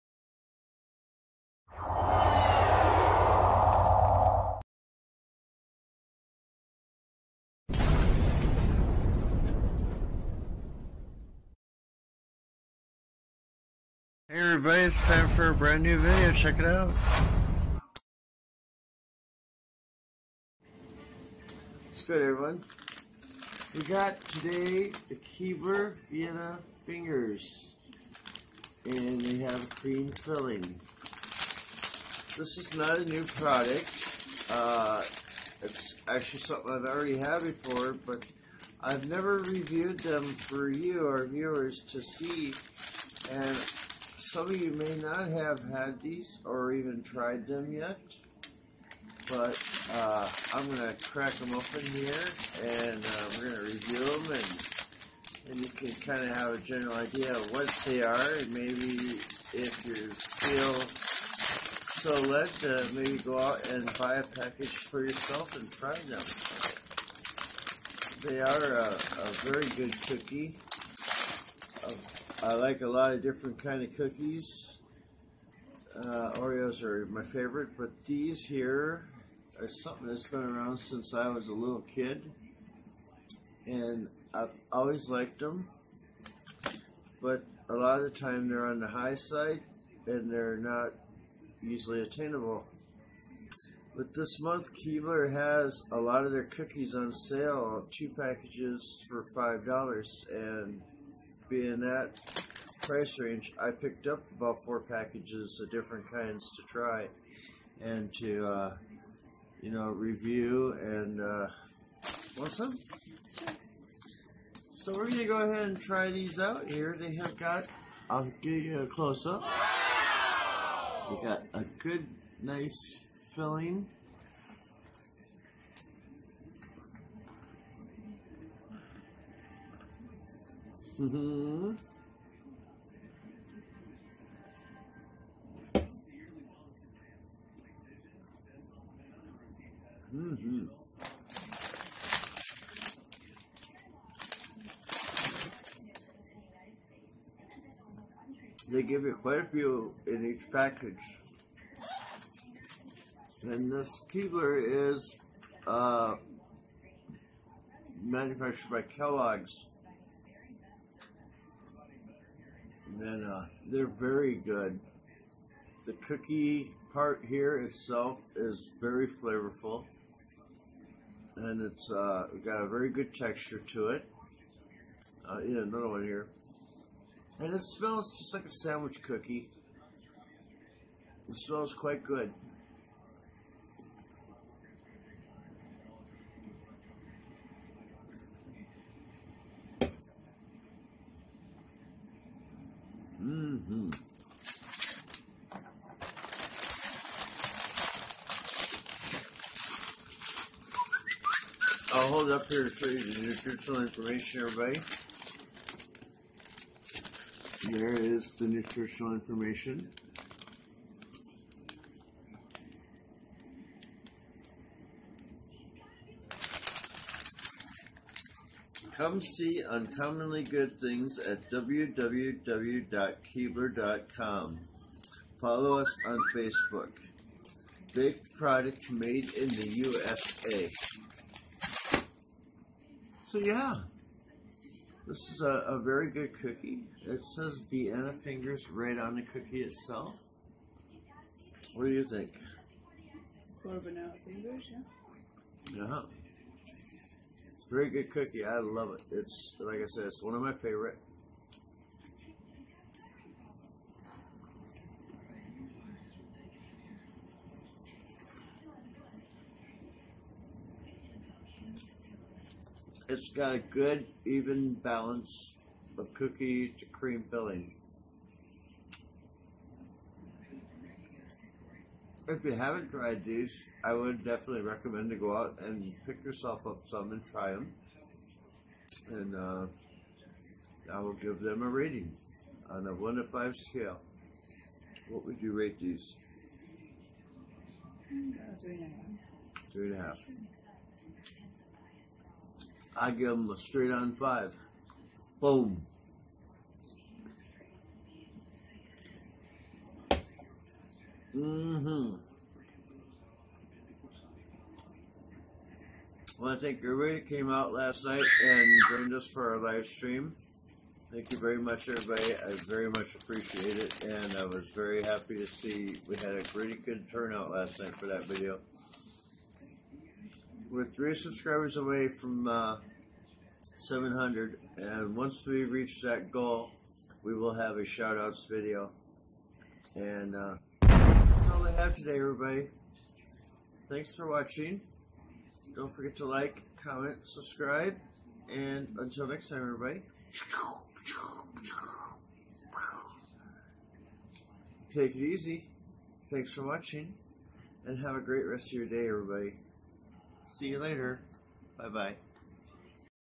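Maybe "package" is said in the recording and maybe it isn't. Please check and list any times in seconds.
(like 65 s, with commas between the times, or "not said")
64 s, 98 s, 104 s, 150 s.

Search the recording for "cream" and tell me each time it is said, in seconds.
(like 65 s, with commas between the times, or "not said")
29 s, 266 s.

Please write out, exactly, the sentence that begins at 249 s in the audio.
It's, like I said, it's one of my favorite.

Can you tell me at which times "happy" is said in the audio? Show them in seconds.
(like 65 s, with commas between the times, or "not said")
315 s.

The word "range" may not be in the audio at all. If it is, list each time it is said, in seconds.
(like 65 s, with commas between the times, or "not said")
103 s.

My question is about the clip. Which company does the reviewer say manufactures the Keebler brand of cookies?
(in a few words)
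Kellogg's.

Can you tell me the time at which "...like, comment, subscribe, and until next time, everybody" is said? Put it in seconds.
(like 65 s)
336 s.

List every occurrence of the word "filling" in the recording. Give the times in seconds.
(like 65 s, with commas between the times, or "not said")
30 s, 123 s, 267 s.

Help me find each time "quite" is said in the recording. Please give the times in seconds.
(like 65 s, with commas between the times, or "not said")
149 s, 181 s.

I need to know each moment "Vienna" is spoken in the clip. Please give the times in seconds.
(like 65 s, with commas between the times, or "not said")
26 s, 237 s.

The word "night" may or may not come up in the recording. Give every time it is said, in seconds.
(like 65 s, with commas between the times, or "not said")
308 s, 317 s.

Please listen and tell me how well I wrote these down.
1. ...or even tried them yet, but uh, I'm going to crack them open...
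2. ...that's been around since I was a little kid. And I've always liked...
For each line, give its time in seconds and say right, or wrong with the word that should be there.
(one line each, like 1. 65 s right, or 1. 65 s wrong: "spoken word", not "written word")
1. 46 s right
2. 80 s right.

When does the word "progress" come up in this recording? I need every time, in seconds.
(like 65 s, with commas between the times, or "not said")
not said.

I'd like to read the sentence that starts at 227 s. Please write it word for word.
Baked product made in the USA.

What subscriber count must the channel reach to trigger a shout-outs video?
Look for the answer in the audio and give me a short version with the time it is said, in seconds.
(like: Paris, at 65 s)
700, at 323 s.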